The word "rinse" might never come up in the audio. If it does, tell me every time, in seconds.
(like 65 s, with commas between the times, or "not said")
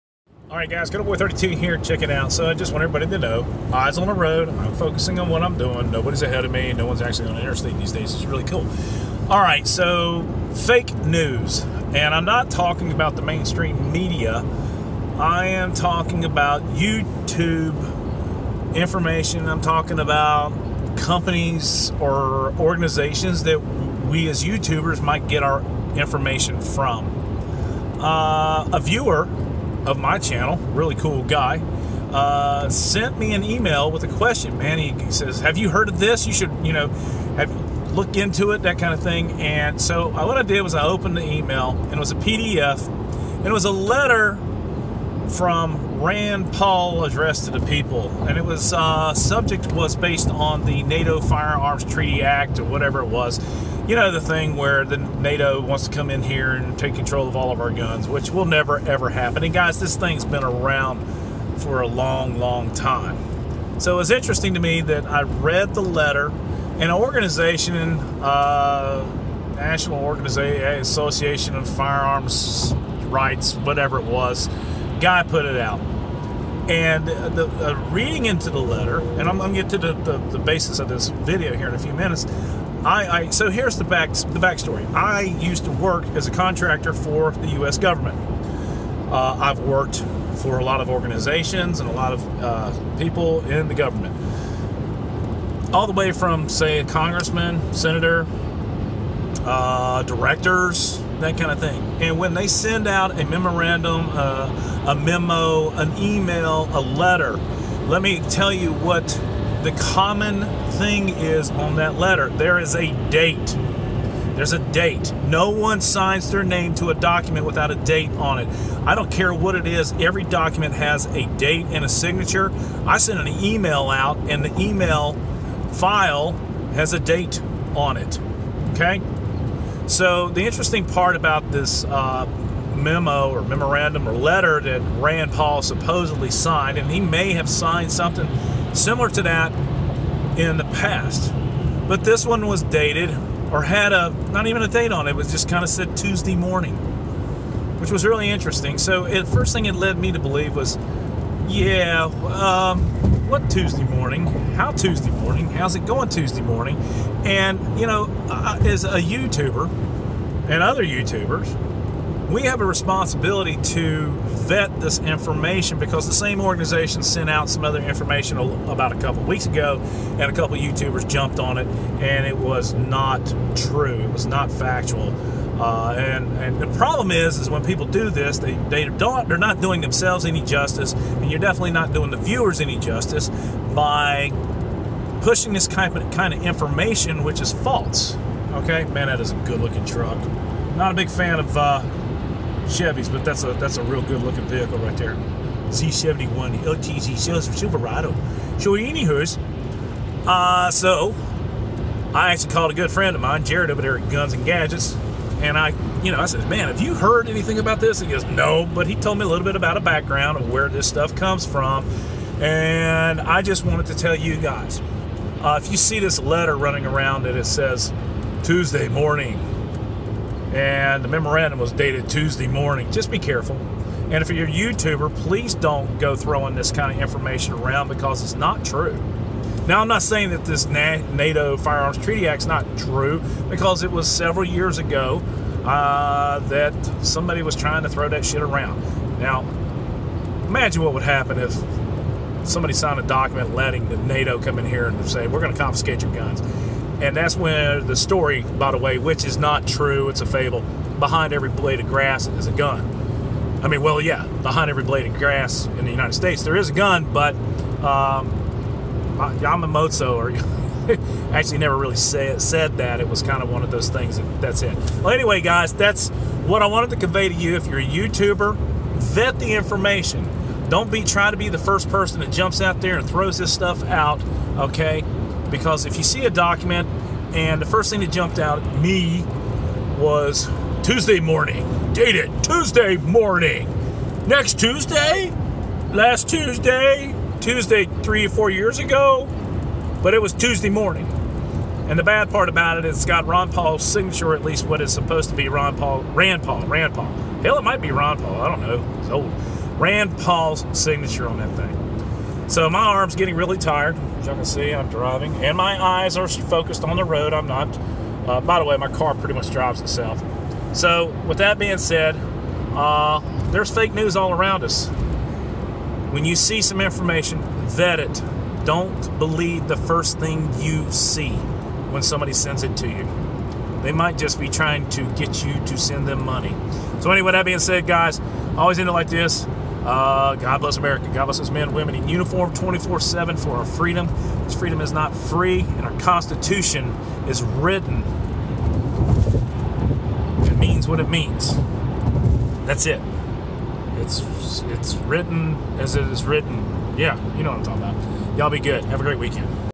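not said.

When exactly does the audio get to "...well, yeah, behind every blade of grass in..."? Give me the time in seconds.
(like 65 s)
253 s.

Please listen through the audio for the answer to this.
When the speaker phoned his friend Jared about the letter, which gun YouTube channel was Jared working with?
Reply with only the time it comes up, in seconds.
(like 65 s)
204 s.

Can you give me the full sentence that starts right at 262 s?
It was kind of one of those things, that, that's it.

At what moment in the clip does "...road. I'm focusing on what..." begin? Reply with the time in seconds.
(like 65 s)
4 s.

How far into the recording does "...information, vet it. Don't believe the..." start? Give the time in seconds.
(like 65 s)
316 s.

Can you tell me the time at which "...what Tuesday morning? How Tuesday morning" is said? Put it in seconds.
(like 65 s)
153 s.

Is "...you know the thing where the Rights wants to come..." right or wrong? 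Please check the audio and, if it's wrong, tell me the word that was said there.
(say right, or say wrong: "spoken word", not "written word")
wrong: "NATO", not "Rights".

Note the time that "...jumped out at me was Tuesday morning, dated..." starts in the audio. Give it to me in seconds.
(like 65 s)
278 s.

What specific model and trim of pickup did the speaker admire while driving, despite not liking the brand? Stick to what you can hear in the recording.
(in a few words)
Z71 LTZ Silverado.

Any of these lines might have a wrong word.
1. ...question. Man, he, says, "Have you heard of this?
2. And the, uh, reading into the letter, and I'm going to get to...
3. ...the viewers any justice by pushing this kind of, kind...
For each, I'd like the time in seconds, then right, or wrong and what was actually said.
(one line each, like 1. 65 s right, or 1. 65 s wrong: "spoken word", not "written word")
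1. 34 s right
2. 76 s right
3. 182 s right.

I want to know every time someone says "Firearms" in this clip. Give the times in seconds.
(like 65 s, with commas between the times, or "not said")
51 s, 71 s, 231 s.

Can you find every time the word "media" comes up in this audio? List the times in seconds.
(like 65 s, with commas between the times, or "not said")
13 s.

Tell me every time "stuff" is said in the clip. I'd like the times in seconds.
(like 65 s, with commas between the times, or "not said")
210 s, 273 s.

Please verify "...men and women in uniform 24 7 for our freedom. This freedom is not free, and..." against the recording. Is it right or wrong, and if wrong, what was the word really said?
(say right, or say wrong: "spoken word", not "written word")
right.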